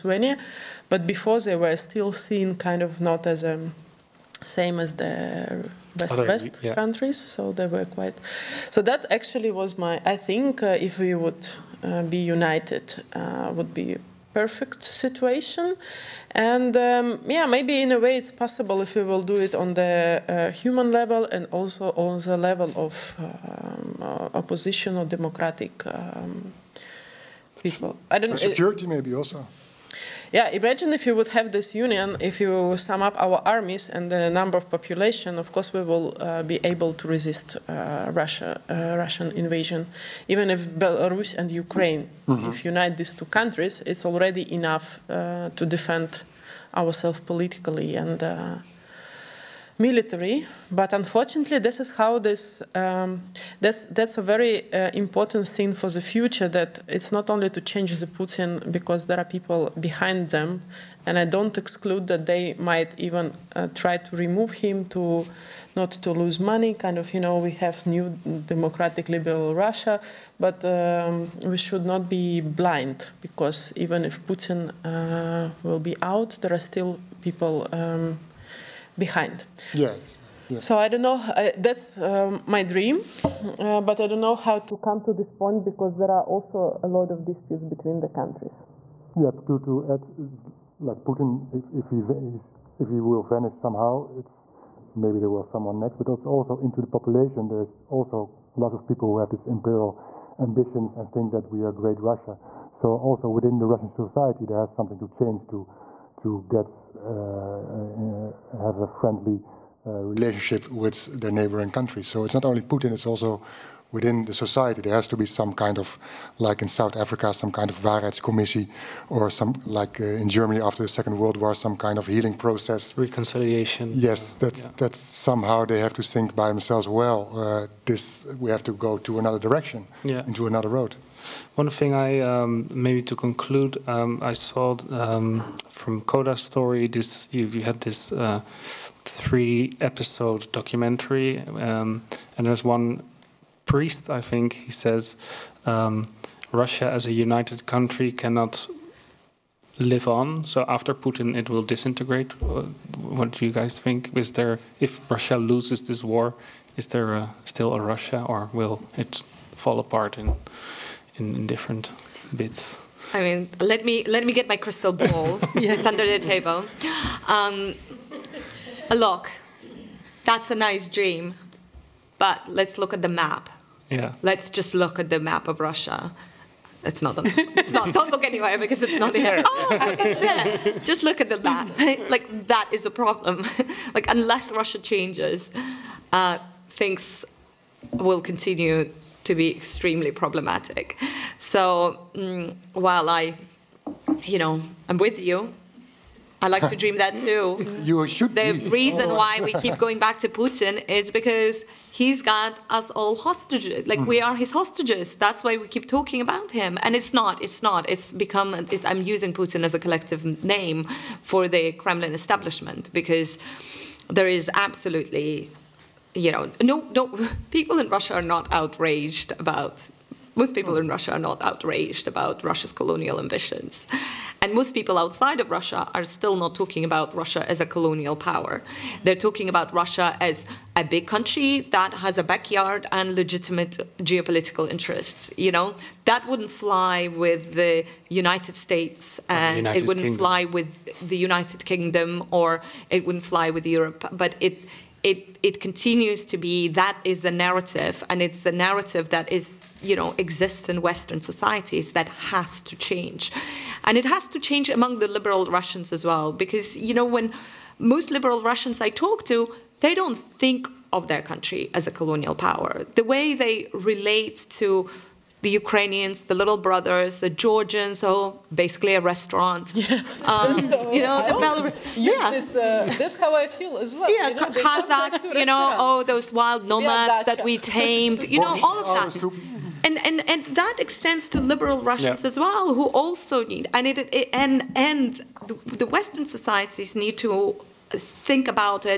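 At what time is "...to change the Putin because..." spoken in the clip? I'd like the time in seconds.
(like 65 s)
57 s.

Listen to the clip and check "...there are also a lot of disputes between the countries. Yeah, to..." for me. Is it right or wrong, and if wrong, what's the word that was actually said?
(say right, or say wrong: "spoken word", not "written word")
right.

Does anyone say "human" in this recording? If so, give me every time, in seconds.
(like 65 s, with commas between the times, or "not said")
20 s.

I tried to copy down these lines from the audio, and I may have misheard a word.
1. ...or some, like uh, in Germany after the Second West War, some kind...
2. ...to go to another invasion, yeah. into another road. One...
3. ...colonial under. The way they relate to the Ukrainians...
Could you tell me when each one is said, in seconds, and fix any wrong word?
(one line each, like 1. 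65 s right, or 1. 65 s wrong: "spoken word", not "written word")
1. 119 s wrong: "World", not "West"
2. 128 s wrong: "direction", not "invasion"
3. 261 s wrong: "power", not "under".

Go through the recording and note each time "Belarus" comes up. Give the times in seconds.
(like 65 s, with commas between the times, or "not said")
40 s, 271 s.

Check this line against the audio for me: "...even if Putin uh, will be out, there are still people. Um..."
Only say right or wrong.
right.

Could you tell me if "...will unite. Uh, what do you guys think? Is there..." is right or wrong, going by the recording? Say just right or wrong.
wrong.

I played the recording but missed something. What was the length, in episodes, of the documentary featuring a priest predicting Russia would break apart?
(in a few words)
3.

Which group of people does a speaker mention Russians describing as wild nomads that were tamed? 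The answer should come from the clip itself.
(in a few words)
Kazakhs.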